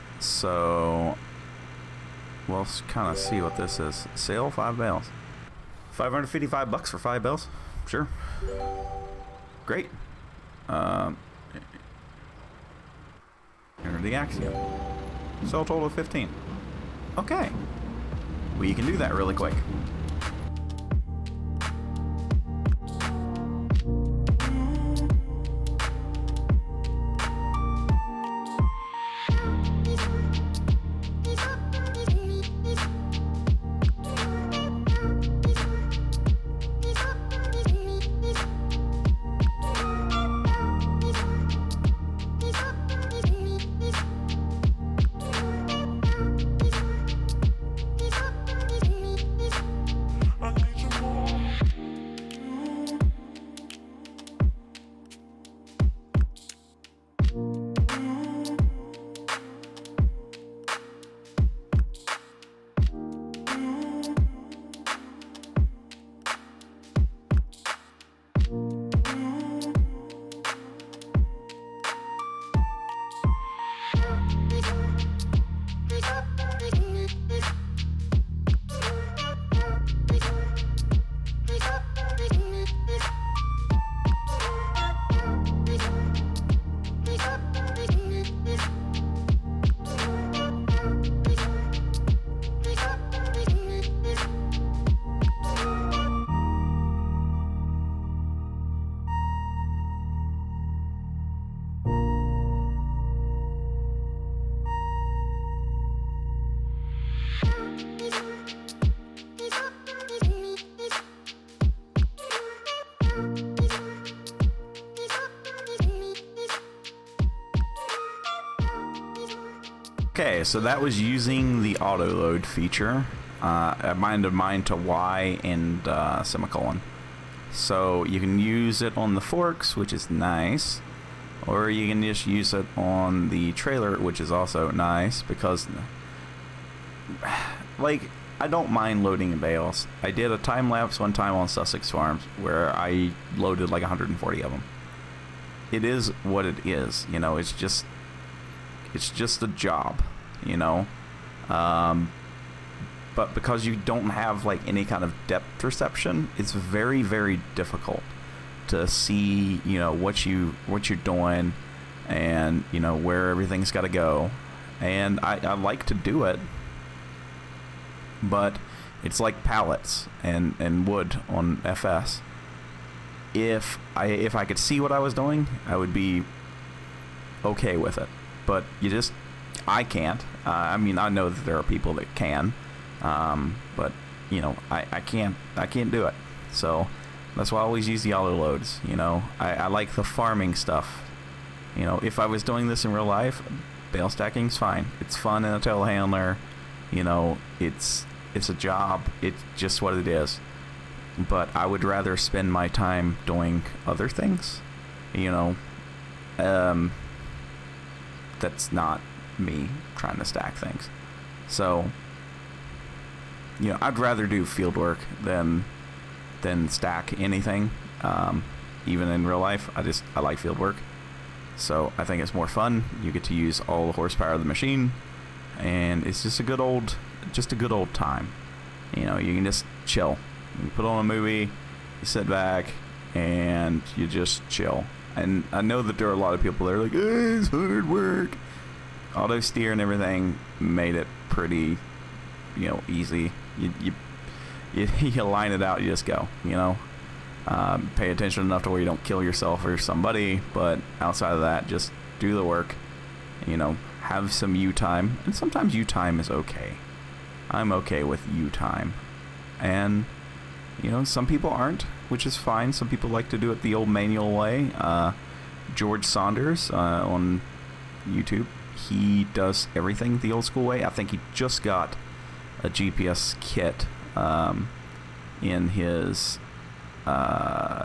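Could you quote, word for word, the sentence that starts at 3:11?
You know, if I was doing this in real life, bale stacking's fine.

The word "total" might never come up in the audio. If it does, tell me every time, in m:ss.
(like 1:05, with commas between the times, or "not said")
0:15.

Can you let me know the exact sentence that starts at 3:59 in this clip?
Auto steer and everything made it pretty, you know, easy.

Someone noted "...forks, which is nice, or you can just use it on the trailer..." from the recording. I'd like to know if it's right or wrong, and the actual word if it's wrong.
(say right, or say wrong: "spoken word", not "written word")
right.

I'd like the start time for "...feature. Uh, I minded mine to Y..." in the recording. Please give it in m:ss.
2:02.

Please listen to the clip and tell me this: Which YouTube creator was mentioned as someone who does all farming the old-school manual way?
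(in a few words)
George Saunders.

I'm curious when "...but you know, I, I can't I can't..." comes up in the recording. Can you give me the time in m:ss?
3:03.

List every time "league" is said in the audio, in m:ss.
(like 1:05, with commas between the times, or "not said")
not said.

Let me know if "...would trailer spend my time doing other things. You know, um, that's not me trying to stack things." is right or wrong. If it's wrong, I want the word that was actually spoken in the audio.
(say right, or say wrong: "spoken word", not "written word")
wrong: "rather", not "trailer".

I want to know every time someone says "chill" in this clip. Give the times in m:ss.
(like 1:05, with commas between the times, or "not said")
3:49, 3:54.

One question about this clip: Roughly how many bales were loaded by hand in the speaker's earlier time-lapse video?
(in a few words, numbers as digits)
140.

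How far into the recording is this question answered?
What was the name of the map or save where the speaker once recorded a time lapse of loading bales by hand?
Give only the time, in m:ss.
2:21.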